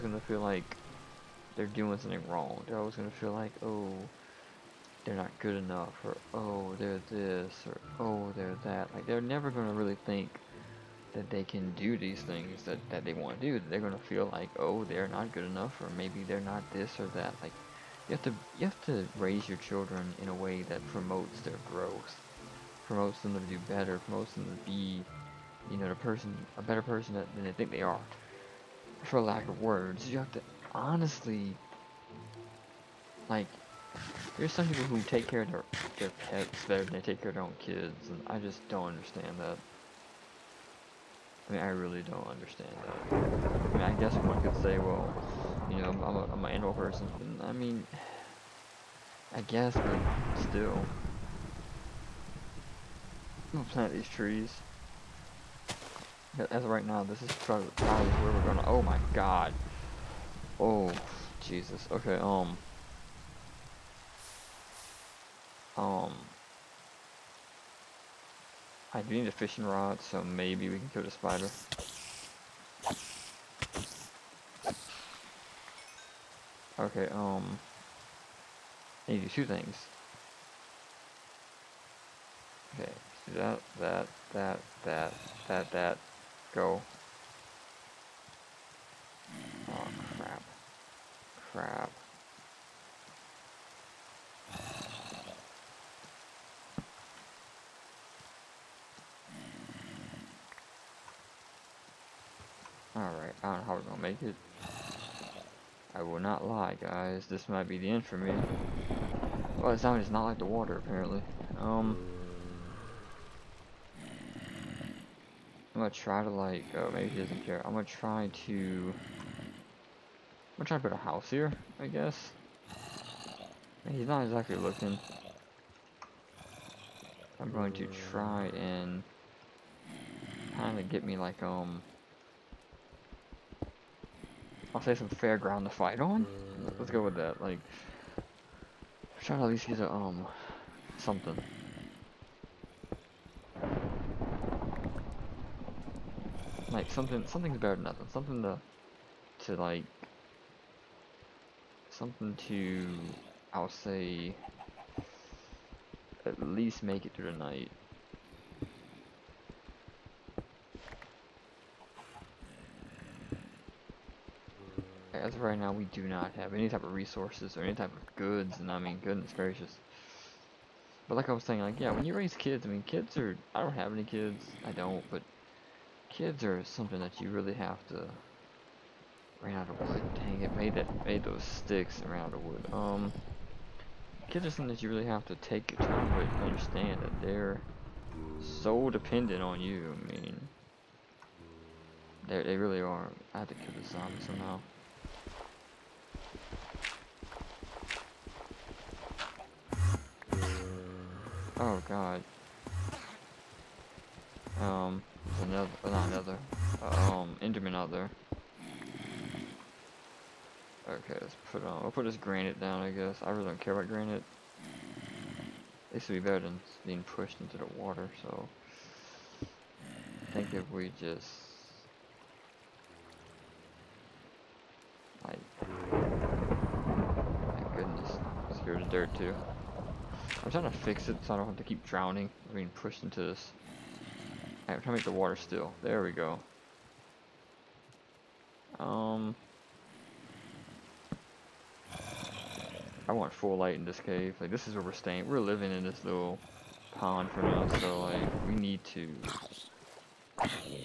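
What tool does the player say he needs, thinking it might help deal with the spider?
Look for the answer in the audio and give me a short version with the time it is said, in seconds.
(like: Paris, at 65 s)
fishing rod, at 69 s.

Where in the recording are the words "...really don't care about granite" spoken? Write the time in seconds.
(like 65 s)
213 s.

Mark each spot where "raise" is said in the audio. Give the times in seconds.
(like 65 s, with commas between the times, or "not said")
19 s, 172 s.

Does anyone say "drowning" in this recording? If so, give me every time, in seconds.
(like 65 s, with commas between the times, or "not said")
231 s.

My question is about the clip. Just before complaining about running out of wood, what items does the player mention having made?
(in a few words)
sticks.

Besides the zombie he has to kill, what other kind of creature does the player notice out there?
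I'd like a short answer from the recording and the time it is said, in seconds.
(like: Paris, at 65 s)
Enderman, at 207 s.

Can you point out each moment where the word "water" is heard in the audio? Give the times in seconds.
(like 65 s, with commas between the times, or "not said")
110 s, 217 s, 235 s.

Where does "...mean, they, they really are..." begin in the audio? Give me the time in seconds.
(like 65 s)
190 s.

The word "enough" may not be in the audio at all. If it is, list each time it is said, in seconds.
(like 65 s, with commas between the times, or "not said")
5 s, 15 s.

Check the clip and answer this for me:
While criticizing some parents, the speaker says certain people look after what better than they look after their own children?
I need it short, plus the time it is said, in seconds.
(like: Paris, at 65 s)
pets, at 36 s.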